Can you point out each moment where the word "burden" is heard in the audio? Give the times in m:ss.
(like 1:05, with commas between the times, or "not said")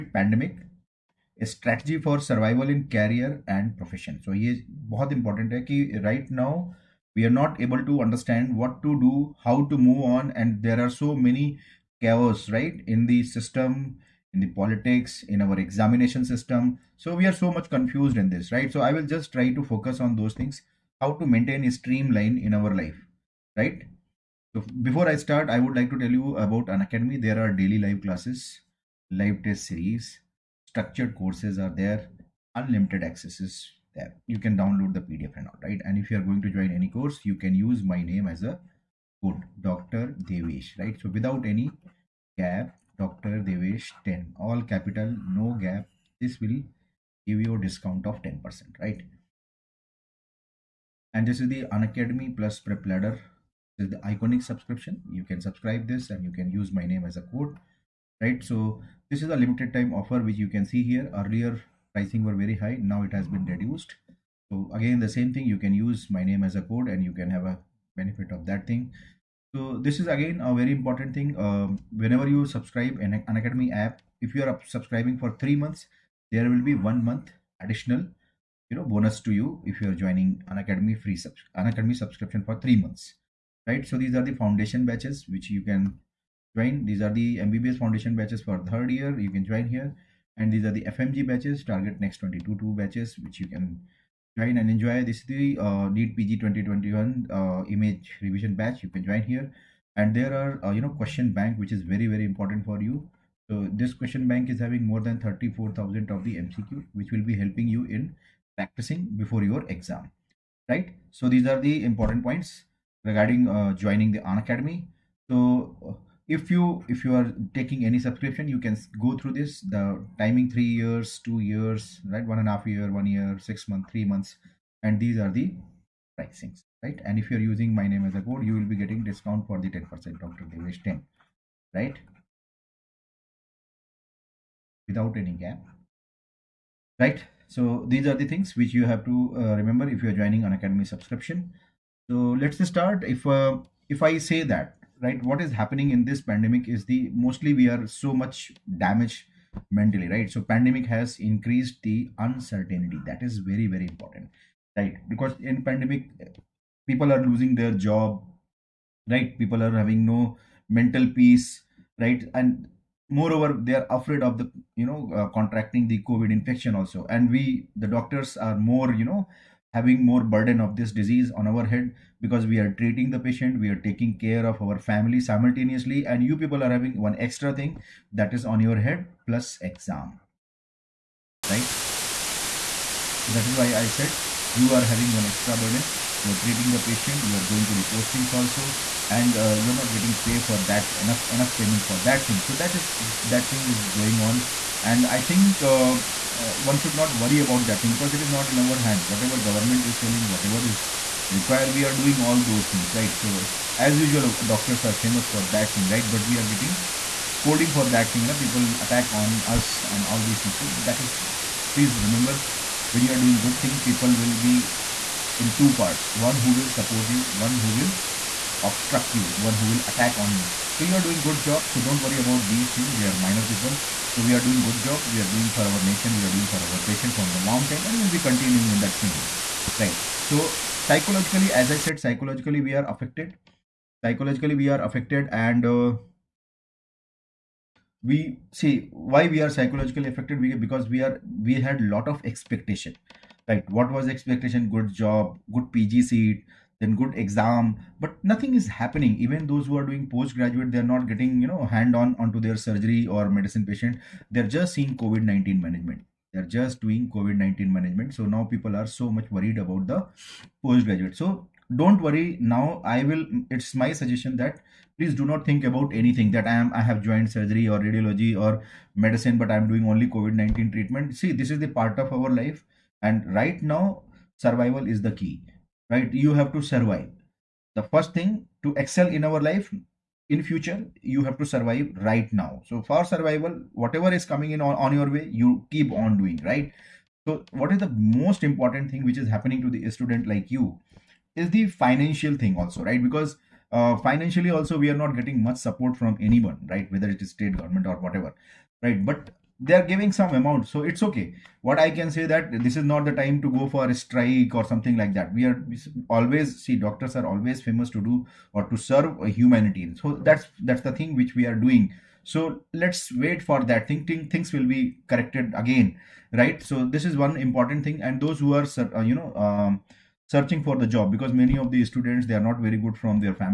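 2:50, 3:05.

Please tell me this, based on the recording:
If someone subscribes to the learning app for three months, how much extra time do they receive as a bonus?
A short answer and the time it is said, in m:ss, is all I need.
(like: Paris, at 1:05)
one month, at 1:16.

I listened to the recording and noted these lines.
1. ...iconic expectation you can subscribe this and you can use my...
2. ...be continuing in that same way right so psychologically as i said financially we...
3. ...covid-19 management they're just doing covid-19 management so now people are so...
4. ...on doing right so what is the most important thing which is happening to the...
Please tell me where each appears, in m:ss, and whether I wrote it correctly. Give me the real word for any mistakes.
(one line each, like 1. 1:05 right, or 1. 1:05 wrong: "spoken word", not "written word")
1. 0:53 wrong: "subscription", not "expectation"
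2. 3:48 wrong: "psychologically", not "financially"
3. 4:15 right
4. 4:45 right.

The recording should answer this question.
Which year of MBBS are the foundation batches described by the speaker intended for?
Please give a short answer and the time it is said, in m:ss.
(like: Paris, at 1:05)
third year, at 1:28.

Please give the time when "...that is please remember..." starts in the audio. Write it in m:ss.
3:30.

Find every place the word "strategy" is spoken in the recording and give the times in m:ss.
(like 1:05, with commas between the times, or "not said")
0:01.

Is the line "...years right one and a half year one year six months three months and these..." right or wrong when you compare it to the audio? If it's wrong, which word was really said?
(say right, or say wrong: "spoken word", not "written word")
right.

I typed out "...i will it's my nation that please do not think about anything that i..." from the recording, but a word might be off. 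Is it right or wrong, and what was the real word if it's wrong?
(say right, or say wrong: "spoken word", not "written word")
wrong: "suggestion", not "nation".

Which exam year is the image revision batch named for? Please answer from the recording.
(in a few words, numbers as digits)
2021.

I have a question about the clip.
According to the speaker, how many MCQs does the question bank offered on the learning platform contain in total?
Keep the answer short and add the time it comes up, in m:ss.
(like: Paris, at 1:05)
more than 34,000, at 1:44.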